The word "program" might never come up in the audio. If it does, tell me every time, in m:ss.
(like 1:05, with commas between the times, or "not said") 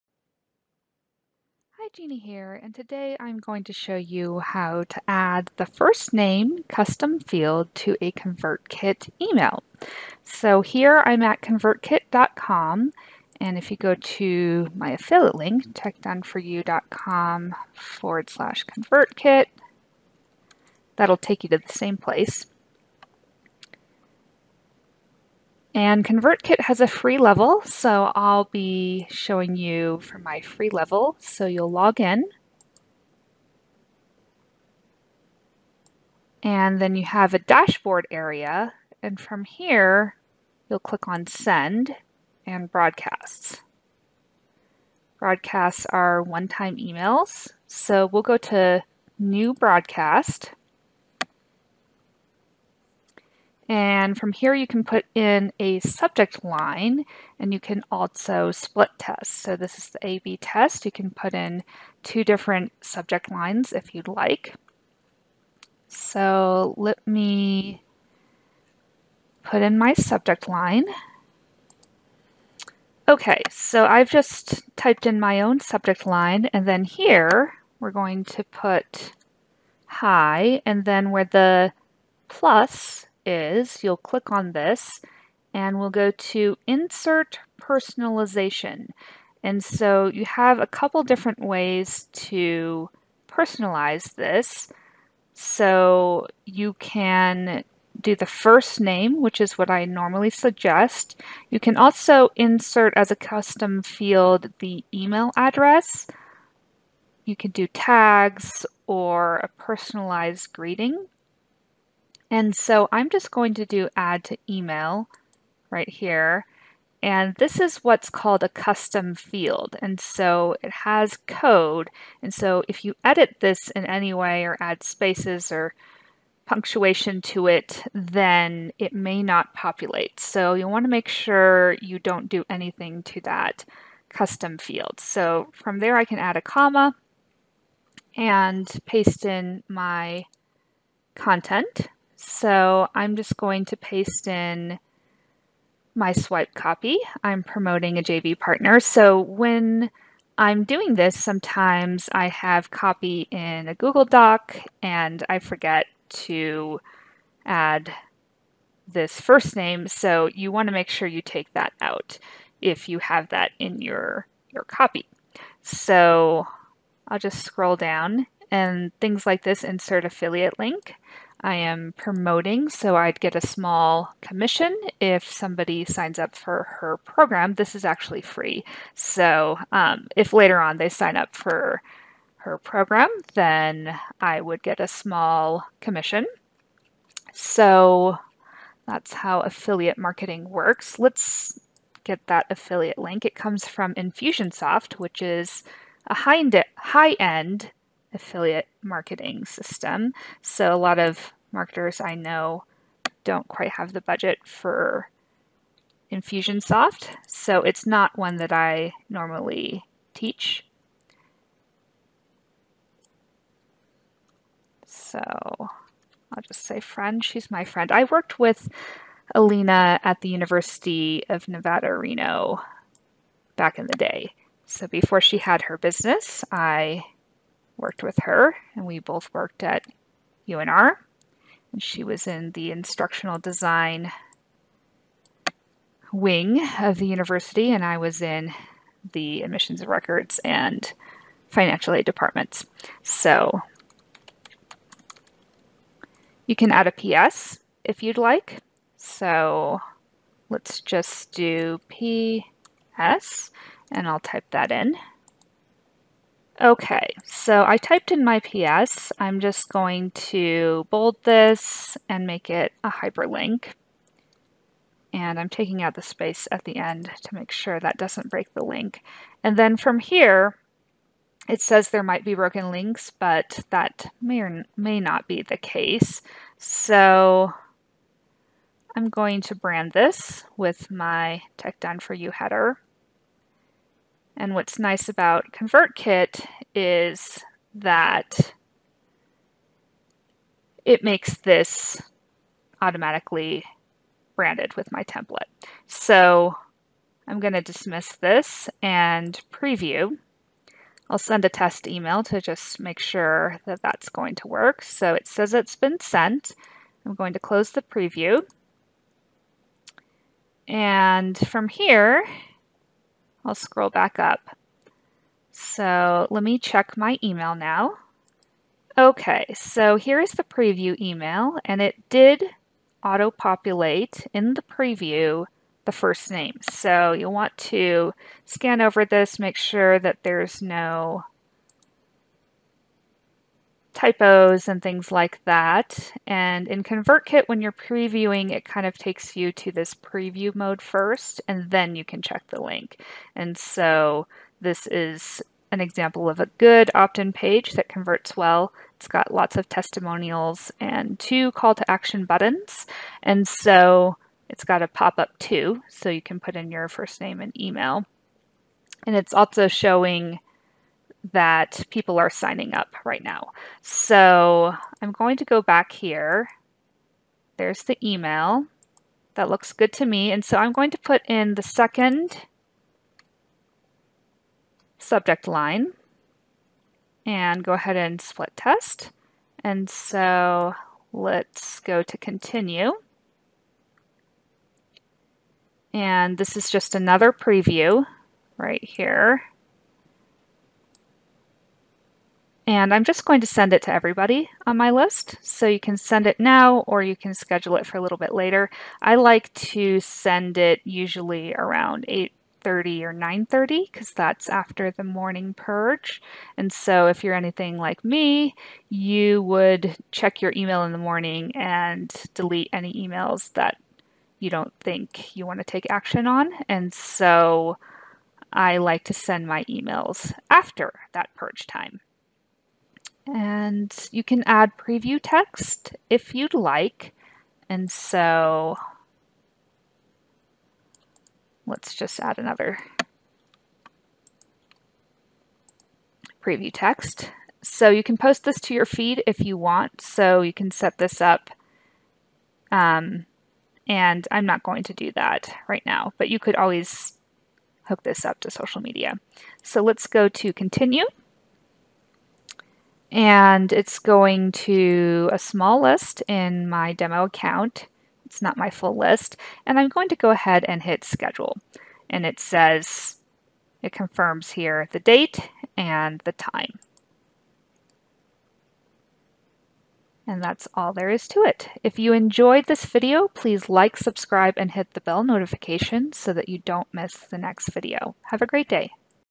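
2:56, 3:02.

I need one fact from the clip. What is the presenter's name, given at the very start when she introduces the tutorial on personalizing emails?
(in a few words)
Gina.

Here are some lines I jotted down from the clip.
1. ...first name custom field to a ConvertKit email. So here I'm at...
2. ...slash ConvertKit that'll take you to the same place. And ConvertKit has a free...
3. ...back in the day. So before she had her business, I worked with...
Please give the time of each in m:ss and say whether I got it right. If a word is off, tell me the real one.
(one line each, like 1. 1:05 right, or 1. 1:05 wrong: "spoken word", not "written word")
1. 0:05 right
2. 0:18 right
3. 3:43 right.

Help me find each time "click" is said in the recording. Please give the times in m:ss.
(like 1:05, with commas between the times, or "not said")
0:40, 1:23.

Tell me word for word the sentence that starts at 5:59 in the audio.
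And it's also showing that people are signing up right now.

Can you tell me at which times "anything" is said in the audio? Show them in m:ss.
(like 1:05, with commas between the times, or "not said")
2:12, 6:47.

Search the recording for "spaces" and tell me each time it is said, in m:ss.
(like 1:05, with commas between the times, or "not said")
2:04, 4:26.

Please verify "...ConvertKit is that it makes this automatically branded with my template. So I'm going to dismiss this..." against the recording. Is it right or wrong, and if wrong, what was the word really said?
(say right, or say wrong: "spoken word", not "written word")
right.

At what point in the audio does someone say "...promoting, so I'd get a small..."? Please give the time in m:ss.
2:51.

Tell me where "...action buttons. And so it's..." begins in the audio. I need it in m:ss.
5:51.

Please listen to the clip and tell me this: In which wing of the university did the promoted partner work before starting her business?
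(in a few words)
instructional design.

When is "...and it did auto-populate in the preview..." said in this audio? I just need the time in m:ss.
5:21.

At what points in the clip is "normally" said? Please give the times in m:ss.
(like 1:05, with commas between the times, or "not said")
1:39, 3:29.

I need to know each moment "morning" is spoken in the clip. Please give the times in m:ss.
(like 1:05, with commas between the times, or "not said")
6:45, 6:50.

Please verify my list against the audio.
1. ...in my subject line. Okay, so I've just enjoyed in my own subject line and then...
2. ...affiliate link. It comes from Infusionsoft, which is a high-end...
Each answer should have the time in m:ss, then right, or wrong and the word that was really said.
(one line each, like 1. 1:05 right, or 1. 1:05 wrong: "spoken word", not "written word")
1. 1:09 wrong: "typed", not "enjoyed"
2. 3:12 right.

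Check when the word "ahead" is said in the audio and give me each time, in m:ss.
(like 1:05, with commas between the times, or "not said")
6:17, 7:40.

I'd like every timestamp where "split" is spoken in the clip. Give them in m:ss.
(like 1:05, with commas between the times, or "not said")
0:58, 6:18.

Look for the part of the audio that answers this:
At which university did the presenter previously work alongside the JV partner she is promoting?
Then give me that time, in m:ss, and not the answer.
3:40.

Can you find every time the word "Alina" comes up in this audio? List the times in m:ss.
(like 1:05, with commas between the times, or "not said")
3:39.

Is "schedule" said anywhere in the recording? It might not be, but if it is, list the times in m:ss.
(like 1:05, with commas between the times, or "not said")
6:37, 7:41.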